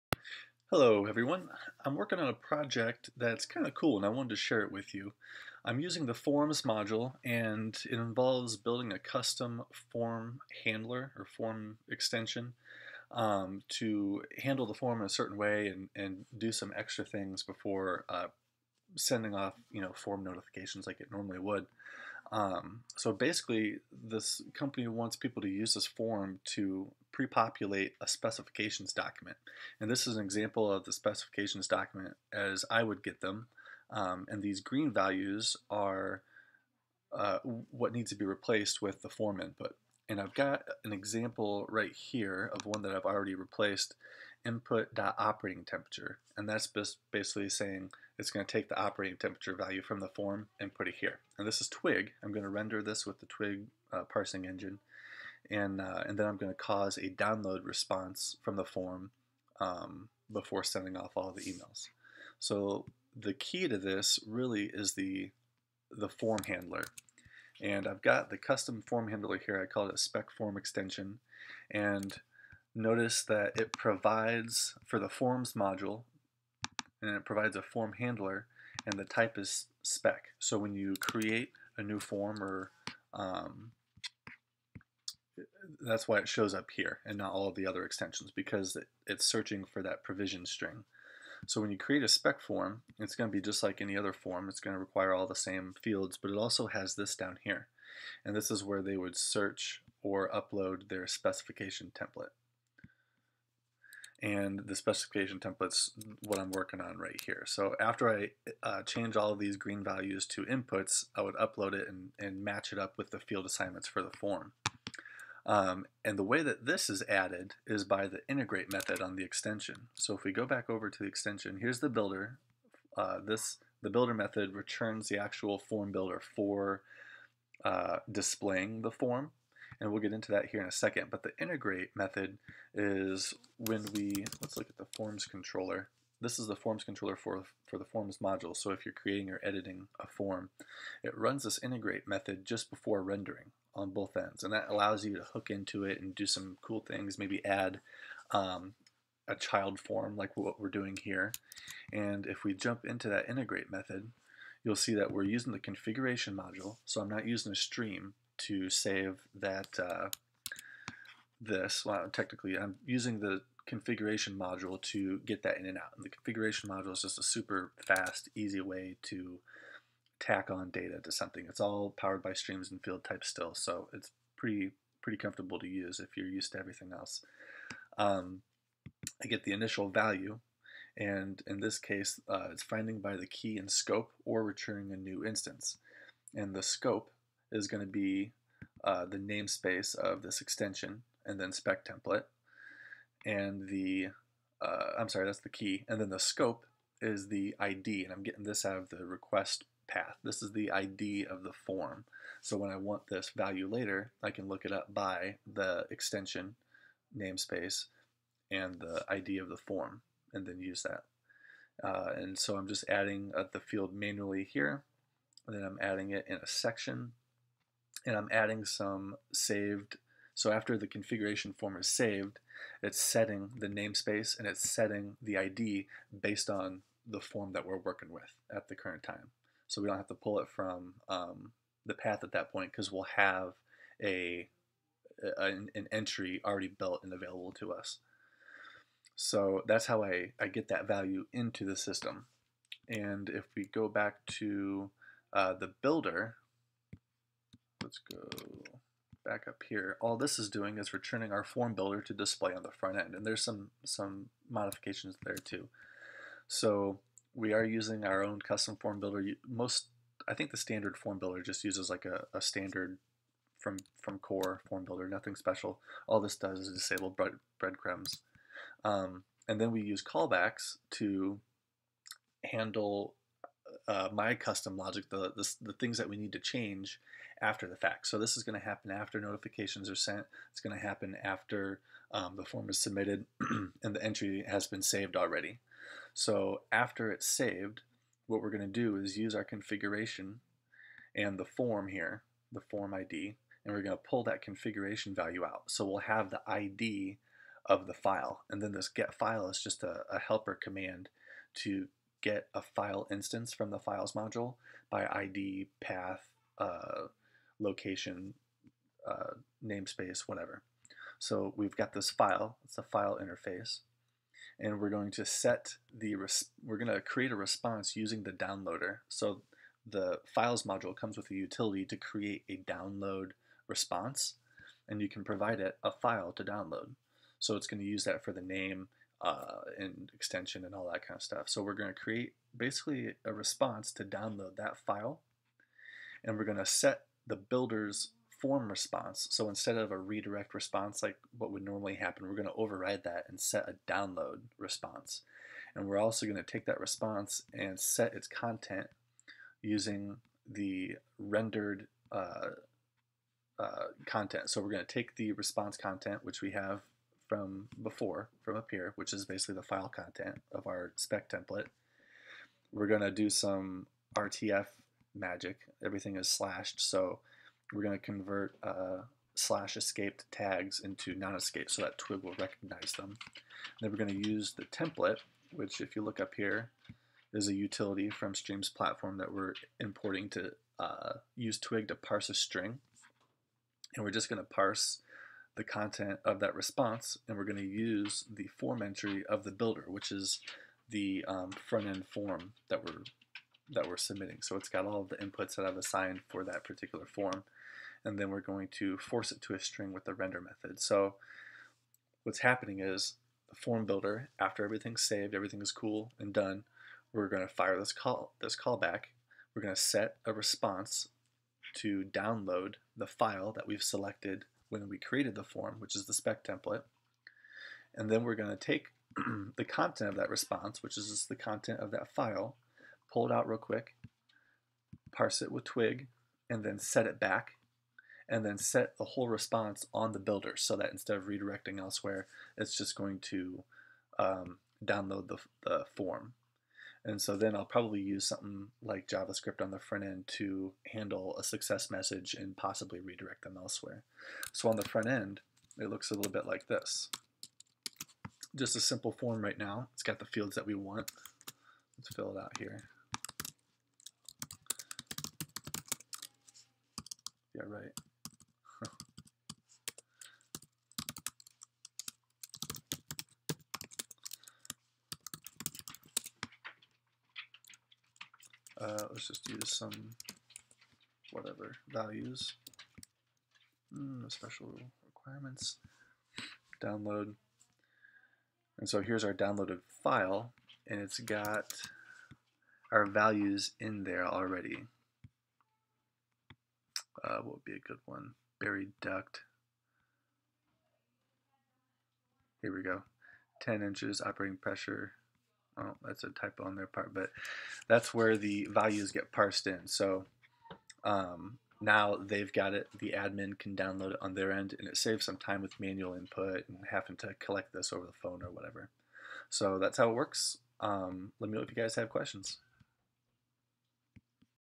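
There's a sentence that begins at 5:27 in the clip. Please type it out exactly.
So it's going to use that for the name, uh, and extension and all that kind of stuff.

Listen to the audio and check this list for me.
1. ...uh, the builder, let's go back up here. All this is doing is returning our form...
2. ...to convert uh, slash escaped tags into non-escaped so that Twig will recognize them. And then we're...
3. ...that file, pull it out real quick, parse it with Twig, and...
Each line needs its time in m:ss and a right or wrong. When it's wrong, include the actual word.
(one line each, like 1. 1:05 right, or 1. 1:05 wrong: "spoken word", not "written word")
1. 4:05 right
2. 6:07 right
3. 7:01 right.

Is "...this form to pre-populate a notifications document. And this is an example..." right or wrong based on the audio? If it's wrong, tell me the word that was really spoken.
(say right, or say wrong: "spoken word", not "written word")
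wrong: "specifications", not "notifications".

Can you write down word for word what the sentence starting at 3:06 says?
And the scope is going to be uh, the namespace of this extension and then spec template.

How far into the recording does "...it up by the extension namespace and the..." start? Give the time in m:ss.
3:24.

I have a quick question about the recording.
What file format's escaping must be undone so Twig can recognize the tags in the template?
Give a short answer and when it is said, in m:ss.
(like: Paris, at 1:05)
RTF, at 6:04.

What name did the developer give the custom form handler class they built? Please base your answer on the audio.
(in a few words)
spec form extension.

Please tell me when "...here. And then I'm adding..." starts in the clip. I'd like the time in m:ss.
3:34.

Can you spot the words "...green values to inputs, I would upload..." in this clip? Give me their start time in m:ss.
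1:49.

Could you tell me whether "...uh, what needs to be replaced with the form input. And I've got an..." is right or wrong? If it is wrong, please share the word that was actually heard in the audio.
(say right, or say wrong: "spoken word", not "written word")
right.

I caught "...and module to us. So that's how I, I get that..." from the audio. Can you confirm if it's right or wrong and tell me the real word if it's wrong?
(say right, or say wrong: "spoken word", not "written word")
wrong: "available", not "module".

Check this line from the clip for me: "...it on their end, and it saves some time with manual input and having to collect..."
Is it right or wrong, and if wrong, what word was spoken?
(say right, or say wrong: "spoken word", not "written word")
right.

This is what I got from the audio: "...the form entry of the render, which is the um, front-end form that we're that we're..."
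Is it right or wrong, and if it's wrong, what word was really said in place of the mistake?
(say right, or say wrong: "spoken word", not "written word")
wrong: "builder", not "render".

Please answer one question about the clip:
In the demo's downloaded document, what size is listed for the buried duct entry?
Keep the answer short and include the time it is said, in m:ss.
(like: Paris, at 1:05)
10 inches, at 8:13.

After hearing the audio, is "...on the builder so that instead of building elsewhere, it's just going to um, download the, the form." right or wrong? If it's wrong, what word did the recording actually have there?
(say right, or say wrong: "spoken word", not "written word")
wrong: "redirecting", not "building".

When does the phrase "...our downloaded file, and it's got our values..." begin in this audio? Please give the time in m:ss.
7:59.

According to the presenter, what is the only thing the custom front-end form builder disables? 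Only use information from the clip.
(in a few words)
breadcrumbs.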